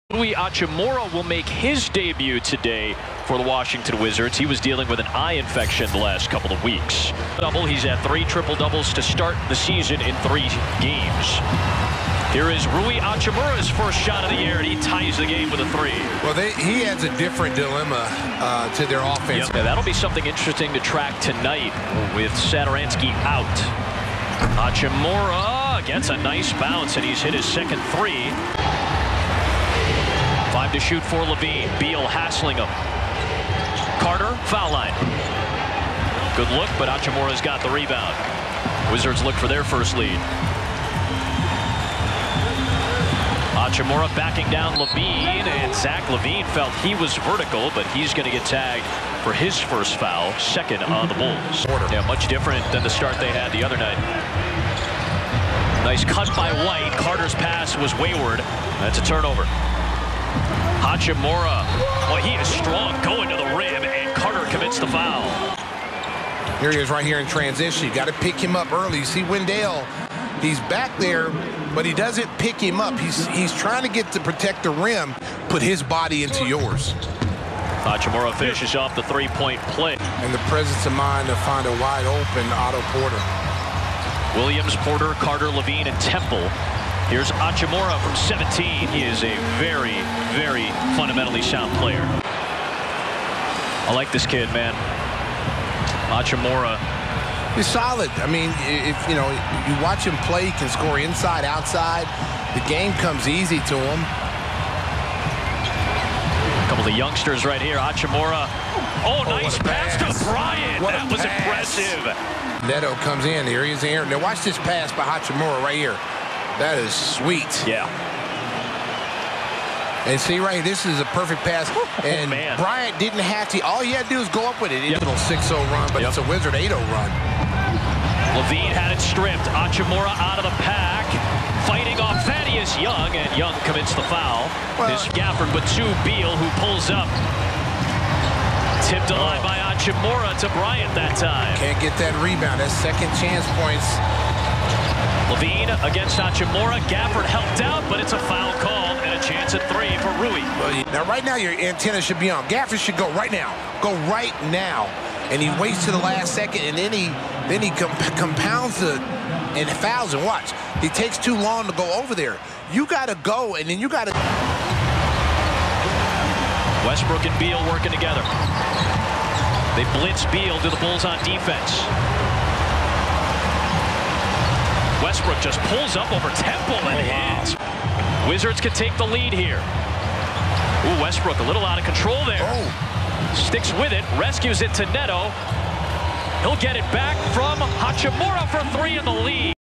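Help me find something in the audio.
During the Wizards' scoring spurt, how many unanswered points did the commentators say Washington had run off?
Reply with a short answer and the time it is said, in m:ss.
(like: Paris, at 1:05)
8-0, at 2:06.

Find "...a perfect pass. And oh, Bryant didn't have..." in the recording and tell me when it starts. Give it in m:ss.
2:00.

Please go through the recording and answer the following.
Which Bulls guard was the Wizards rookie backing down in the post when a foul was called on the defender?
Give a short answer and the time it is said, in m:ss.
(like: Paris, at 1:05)
Zach LaVine, at 0:45.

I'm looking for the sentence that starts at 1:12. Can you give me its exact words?
He's, he's trying to get to protect the rim, put his body into yours.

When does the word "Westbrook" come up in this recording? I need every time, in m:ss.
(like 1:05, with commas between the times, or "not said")
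2:46, 2:55, 3:01.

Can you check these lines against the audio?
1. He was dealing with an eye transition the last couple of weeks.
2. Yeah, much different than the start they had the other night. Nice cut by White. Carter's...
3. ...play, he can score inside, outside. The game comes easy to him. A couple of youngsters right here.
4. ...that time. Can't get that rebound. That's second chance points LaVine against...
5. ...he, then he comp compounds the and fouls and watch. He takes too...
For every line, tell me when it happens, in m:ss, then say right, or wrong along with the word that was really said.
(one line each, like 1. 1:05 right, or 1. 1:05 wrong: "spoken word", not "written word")
1. 0:04 wrong: "infection", not "transition"
2. 0:51 right
3. 1:40 right
4. 2:20 right
5. 2:36 right.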